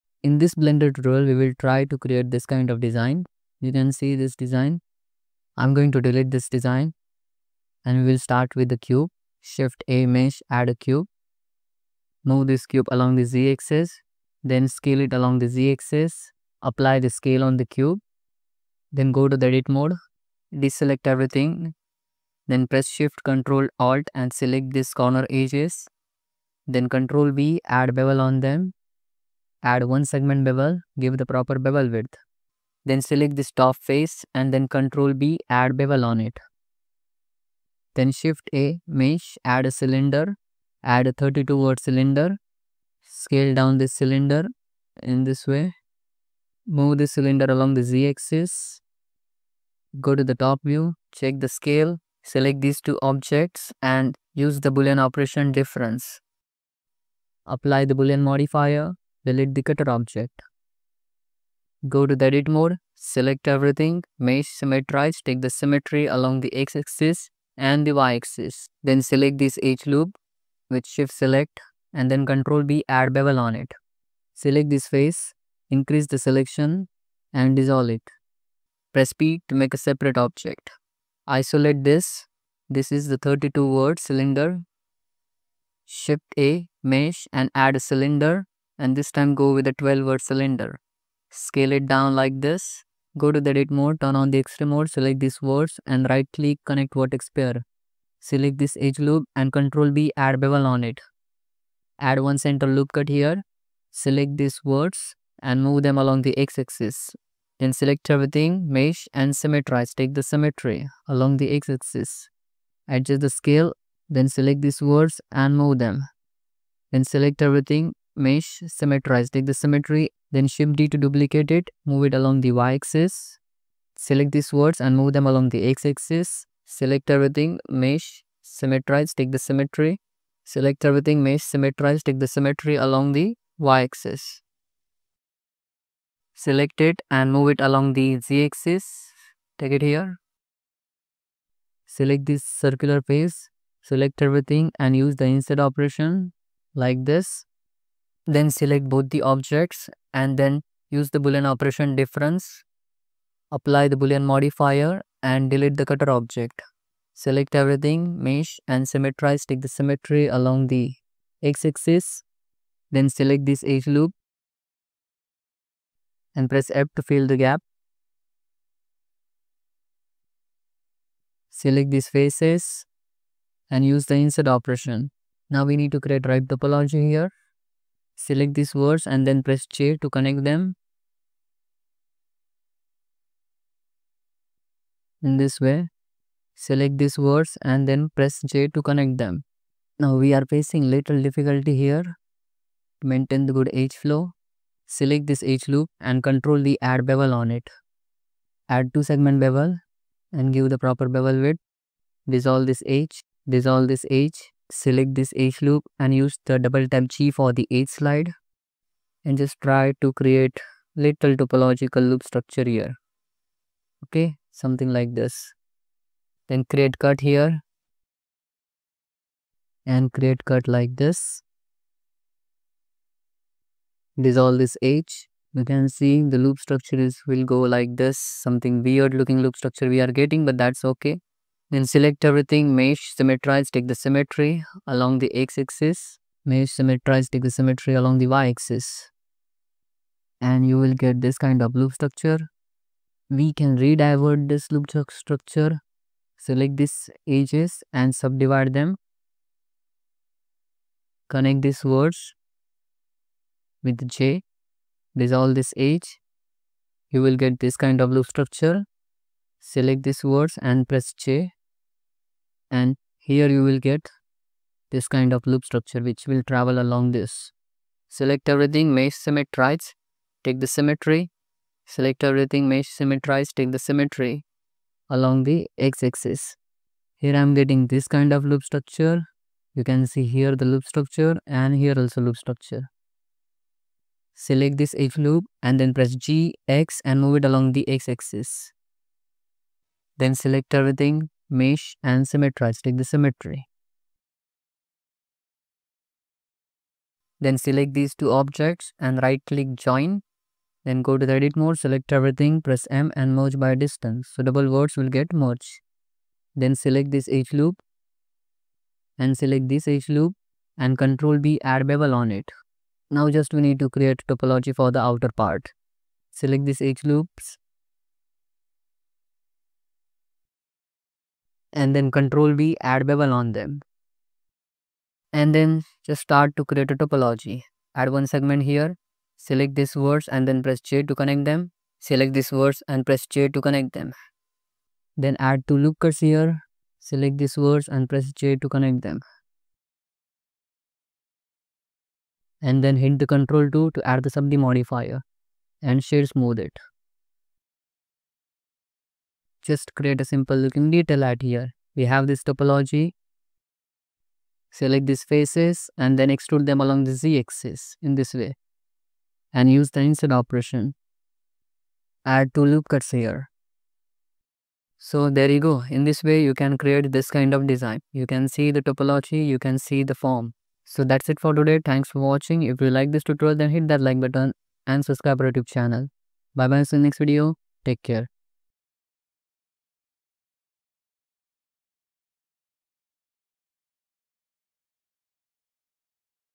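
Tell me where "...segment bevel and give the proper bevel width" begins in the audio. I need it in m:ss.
3:19.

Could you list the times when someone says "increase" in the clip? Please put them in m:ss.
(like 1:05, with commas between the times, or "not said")
1:15.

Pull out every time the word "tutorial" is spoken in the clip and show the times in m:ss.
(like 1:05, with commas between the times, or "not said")
0:00, 6:13.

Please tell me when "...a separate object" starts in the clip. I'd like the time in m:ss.
1:19.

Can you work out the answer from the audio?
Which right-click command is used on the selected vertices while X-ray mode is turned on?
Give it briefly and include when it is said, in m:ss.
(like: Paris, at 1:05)
Connect vertex pair, at 1:36.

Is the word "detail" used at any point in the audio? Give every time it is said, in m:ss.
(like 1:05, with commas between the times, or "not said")
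5:50.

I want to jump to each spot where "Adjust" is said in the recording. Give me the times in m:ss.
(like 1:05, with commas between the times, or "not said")
1:52.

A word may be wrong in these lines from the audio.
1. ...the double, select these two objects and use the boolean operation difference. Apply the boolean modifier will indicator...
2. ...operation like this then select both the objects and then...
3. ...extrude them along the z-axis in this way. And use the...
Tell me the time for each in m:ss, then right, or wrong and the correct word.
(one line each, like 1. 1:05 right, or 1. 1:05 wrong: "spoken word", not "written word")
1. 0:51 wrong: "scale", not "double"
2. 2:25 right
3. 5:56 right.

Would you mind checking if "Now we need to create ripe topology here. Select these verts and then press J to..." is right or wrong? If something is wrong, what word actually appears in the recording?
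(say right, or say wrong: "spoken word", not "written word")
right.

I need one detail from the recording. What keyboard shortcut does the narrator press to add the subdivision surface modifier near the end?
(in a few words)
Control 2.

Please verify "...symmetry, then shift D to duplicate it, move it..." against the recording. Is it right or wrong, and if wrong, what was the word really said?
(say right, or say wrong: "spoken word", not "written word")
right.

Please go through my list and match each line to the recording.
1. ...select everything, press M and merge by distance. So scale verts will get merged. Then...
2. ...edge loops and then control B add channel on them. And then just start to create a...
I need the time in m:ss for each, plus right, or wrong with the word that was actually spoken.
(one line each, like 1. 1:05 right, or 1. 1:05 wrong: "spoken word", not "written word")
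1. 5:01 wrong: "double", not "scale"
2. 5:16 wrong: "bevel", not "channel".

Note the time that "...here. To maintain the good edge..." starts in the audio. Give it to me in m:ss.
3:11.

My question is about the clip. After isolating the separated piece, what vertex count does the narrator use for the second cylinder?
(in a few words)
12.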